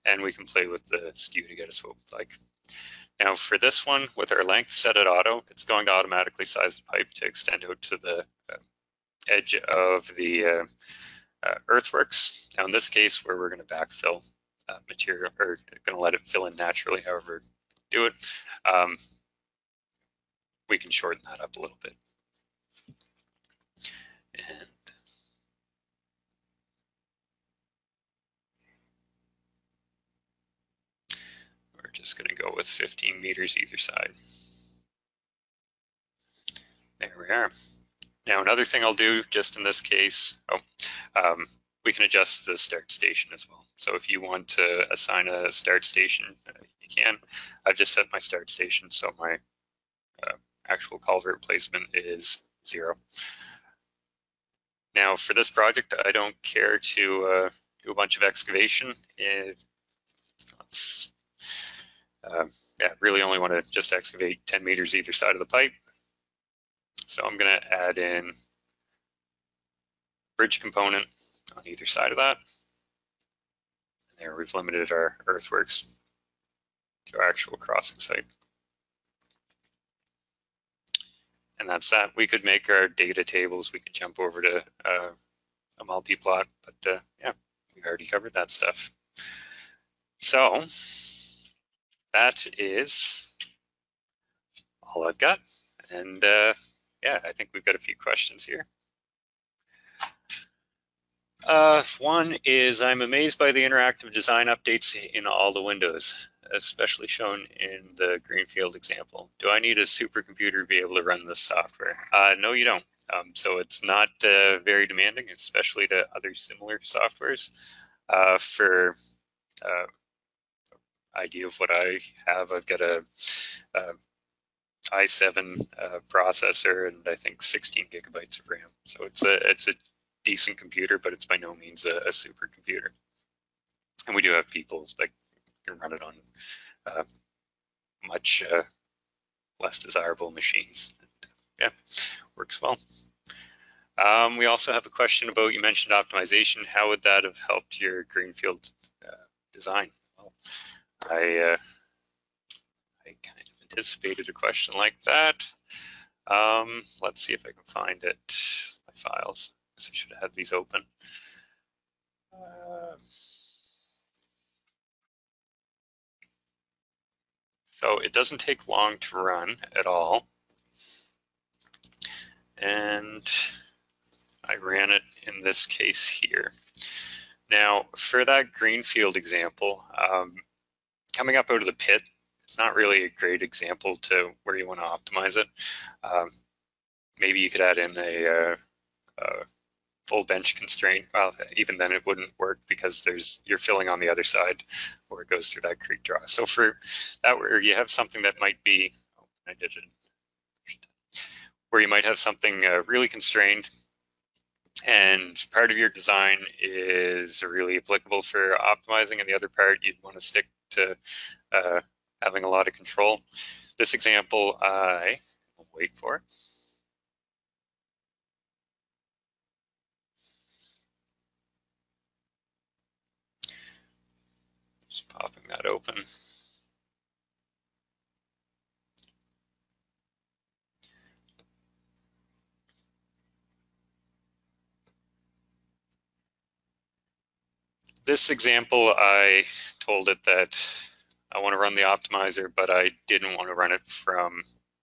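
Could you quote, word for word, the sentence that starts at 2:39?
So I should have had these open.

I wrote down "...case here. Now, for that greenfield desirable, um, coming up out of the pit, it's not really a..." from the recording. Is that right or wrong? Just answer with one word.
wrong.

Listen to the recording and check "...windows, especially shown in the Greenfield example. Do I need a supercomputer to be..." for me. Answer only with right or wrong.
right.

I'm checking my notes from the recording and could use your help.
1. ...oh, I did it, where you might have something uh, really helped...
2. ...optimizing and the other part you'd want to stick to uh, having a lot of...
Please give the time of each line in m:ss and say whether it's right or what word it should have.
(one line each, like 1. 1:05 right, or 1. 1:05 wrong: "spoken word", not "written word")
1. 3:19 wrong: "constrained", not "helped"
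2. 3:28 right.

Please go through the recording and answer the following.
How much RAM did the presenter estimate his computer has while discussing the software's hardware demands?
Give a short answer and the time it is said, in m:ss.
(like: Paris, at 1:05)
16 gigabytes, at 2:07.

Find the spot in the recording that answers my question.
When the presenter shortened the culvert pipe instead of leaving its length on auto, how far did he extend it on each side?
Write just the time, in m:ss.
0:32.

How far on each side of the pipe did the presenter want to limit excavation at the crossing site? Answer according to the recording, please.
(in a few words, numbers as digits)
10 meters.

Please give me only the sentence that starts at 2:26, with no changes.
How would that have helped your greenfield uh, design?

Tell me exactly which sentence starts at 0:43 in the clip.
So if you want to assign a start station, you can.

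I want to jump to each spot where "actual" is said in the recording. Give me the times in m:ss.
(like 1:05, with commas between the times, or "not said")
0:50, 1:17.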